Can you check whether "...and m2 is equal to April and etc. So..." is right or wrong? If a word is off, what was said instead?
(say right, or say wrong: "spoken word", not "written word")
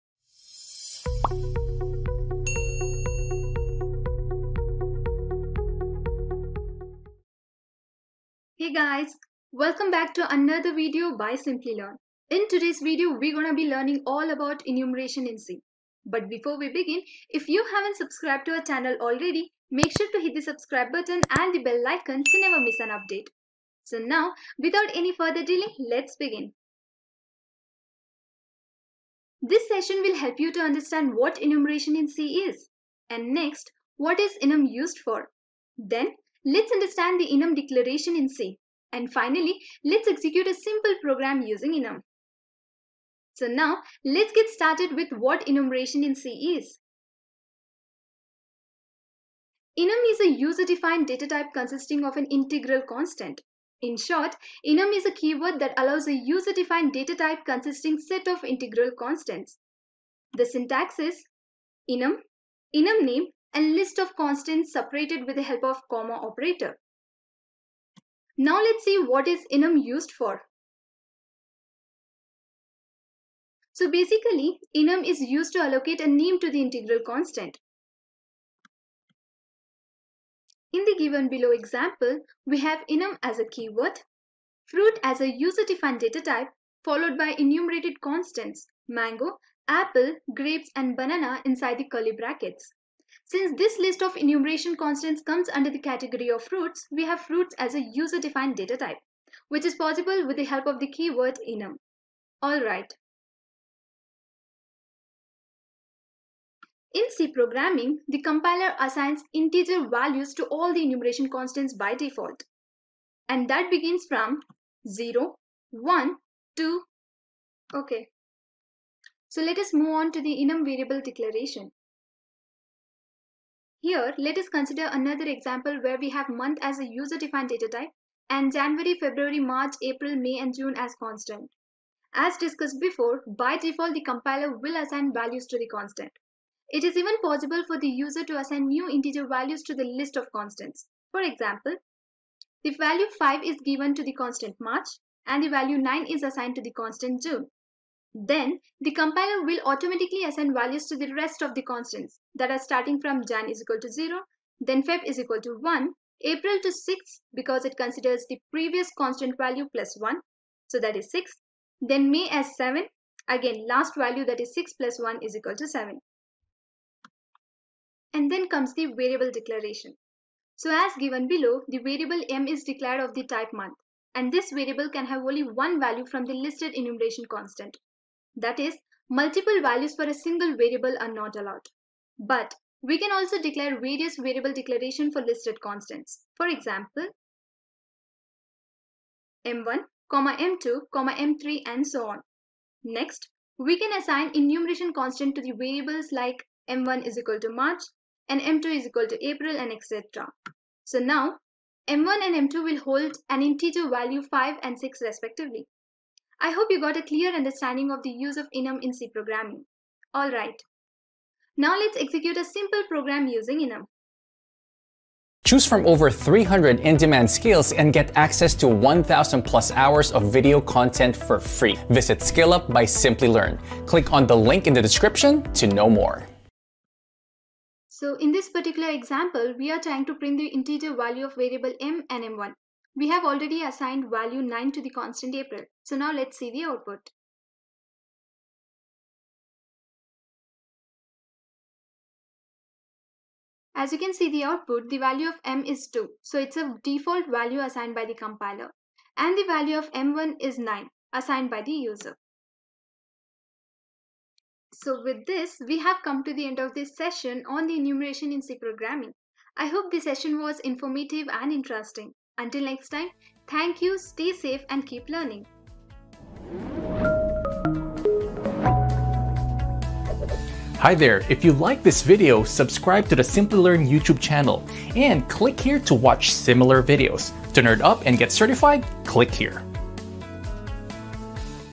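right.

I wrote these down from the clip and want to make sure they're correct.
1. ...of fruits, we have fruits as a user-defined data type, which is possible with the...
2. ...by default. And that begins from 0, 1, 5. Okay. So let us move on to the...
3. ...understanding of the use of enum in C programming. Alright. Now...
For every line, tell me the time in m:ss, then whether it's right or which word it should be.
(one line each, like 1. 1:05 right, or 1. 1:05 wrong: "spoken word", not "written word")
1. 1:36 right
2. 1:51 wrong: "2", not "5"
3. 3:27 right.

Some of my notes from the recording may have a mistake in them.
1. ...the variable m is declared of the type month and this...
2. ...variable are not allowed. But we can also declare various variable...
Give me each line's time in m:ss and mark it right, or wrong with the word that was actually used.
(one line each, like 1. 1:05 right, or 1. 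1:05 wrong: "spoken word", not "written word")
1. 2:51 right
2. 3:00 right.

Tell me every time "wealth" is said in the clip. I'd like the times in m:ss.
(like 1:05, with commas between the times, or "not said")
not said.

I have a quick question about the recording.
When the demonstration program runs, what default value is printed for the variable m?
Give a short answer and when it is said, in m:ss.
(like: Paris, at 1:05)
2, at 4:04.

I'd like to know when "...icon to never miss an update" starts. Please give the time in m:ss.
0:21.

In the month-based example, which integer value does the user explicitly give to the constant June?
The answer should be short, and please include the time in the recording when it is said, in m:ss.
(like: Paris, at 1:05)
9, at 2:25.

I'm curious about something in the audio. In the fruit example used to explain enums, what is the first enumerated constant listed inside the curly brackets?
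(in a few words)
mango.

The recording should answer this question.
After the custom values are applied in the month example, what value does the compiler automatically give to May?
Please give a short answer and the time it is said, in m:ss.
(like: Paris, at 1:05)
7, at 2:42.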